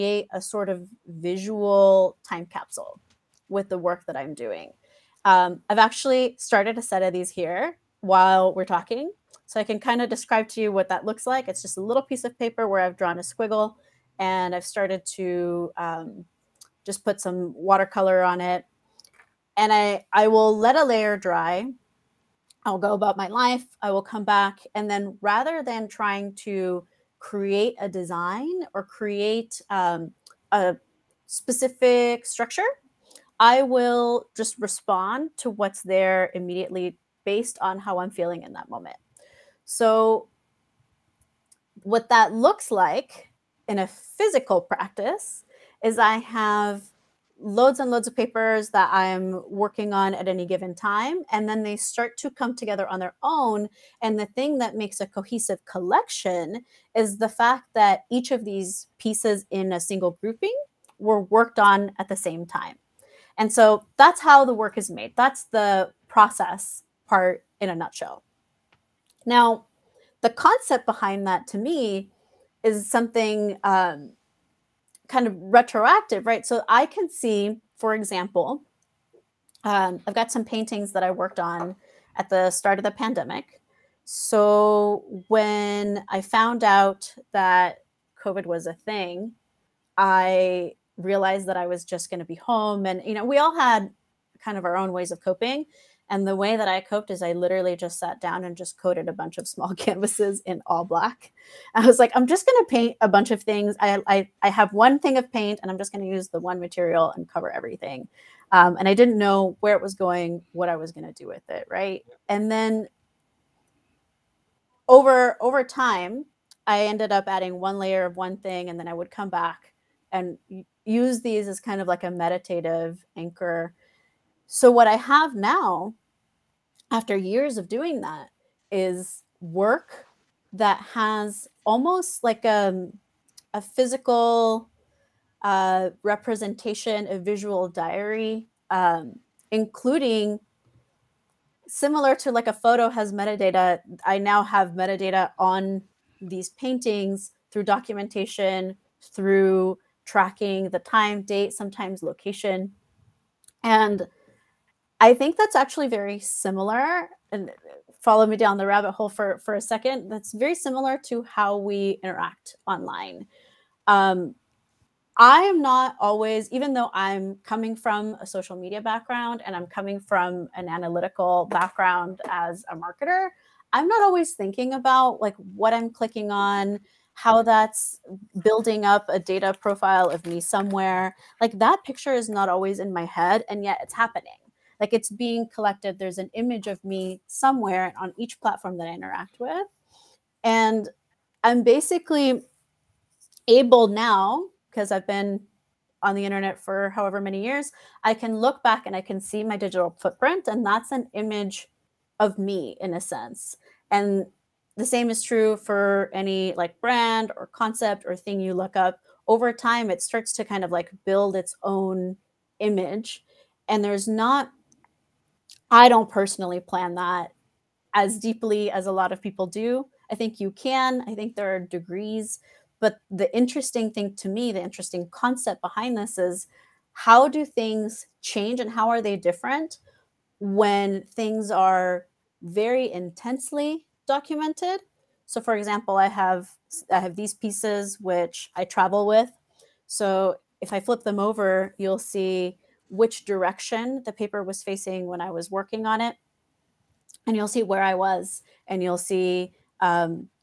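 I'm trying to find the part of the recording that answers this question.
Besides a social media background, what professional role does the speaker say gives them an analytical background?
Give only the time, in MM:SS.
02:52.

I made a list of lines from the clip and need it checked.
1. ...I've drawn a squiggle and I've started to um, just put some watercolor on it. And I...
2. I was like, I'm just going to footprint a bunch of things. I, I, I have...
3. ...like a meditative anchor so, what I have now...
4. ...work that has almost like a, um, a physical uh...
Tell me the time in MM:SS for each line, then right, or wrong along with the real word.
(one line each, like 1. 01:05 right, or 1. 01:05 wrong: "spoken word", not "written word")
1. 00:12 right
2. 01:41 wrong: "paint", not "footprint"
3. 02:01 right
4. 02:09 right.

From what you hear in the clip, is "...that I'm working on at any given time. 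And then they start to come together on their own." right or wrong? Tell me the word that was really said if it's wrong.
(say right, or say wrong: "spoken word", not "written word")
right.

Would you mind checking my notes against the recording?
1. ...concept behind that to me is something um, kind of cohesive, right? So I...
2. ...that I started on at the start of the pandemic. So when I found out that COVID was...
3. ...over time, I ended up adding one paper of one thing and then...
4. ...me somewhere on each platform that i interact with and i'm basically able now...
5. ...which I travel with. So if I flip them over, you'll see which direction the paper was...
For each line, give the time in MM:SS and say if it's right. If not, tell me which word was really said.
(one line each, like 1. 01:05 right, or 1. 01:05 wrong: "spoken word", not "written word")
1. 01:10 wrong: "retroactive", not "cohesive"
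2. 01:20 wrong: "worked", not "started"
3. 01:55 wrong: "layer", not "paper"
4. 03:06 right
5. 03:57 right.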